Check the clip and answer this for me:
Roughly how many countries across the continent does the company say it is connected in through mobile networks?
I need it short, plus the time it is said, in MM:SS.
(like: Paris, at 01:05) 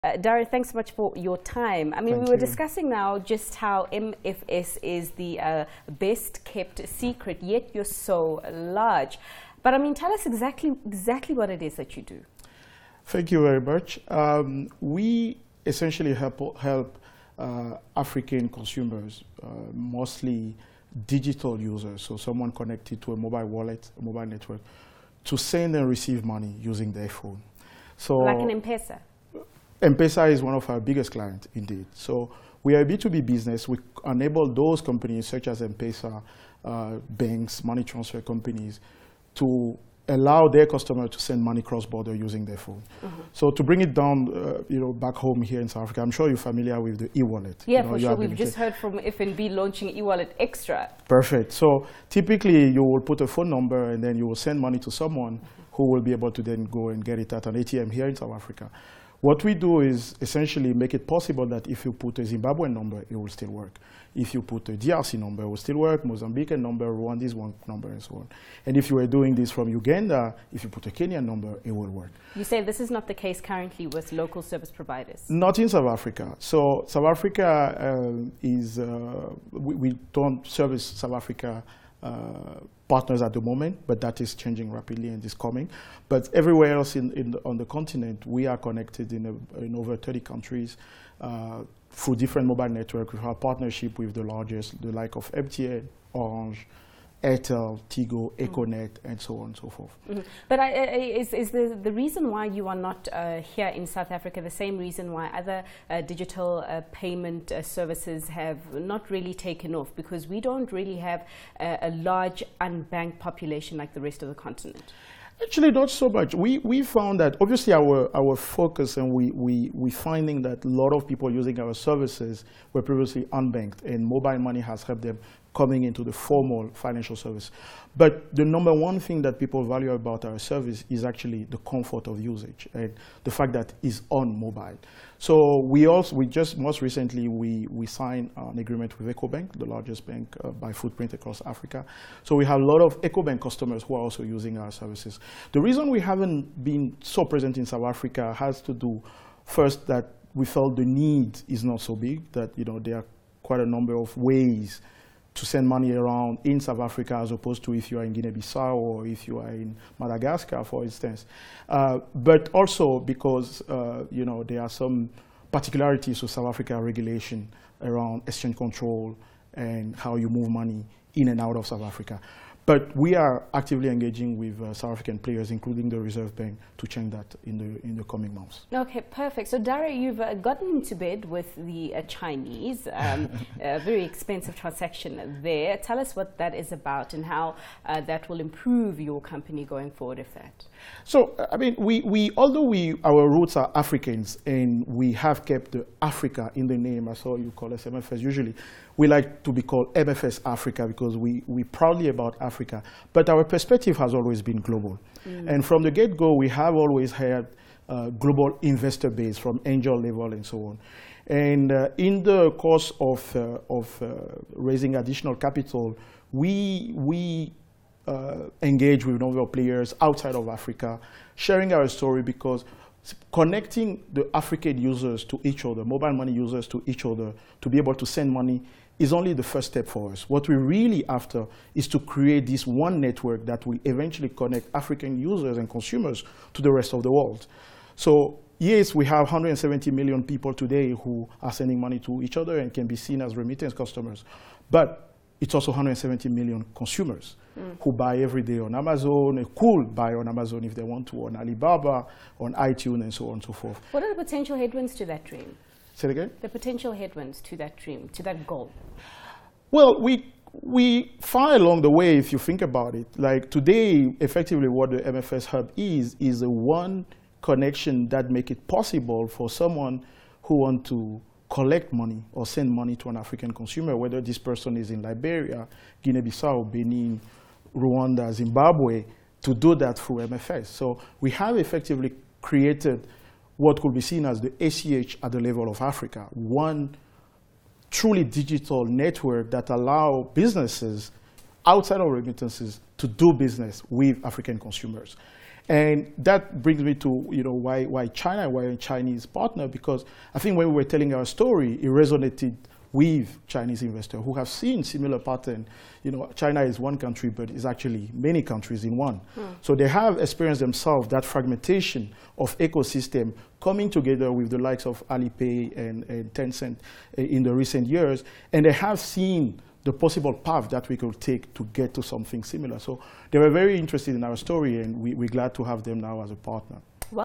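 over 30, at 01:29.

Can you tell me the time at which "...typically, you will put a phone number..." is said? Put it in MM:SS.
00:52.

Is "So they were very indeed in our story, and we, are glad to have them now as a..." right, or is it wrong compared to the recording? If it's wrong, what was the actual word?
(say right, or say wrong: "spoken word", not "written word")
wrong: "interested", not "indeed".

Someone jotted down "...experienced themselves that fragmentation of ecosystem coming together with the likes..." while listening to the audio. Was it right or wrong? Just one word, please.
right.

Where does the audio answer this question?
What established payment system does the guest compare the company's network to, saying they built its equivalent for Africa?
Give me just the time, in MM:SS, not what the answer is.
04:44.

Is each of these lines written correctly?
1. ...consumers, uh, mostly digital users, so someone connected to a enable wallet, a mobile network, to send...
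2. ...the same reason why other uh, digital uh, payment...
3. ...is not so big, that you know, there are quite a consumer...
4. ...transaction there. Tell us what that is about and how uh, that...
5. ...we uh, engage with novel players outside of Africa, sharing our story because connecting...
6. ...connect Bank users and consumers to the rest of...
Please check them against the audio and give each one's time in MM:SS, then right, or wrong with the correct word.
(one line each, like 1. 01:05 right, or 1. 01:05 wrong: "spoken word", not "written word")
1. 00:18 wrong: "mobile", not "enable"
2. 01:44 right
3. 02:31 wrong: "number", not "consumer"
4. 03:04 right
5. 03:36 right
6. 03:54 wrong: "African", not "Bank".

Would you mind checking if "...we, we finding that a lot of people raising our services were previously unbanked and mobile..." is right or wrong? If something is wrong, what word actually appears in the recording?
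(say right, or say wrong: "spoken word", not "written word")
wrong: "using", not "raising".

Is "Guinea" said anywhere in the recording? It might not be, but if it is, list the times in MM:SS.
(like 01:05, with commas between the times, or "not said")
02:38, 04:36.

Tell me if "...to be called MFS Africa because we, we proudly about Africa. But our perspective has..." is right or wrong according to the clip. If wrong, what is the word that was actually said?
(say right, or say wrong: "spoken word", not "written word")
right.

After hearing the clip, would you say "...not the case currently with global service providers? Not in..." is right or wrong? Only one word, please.
wrong.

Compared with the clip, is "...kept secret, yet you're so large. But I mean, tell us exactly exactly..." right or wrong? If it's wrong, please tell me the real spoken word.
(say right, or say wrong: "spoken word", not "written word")
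right.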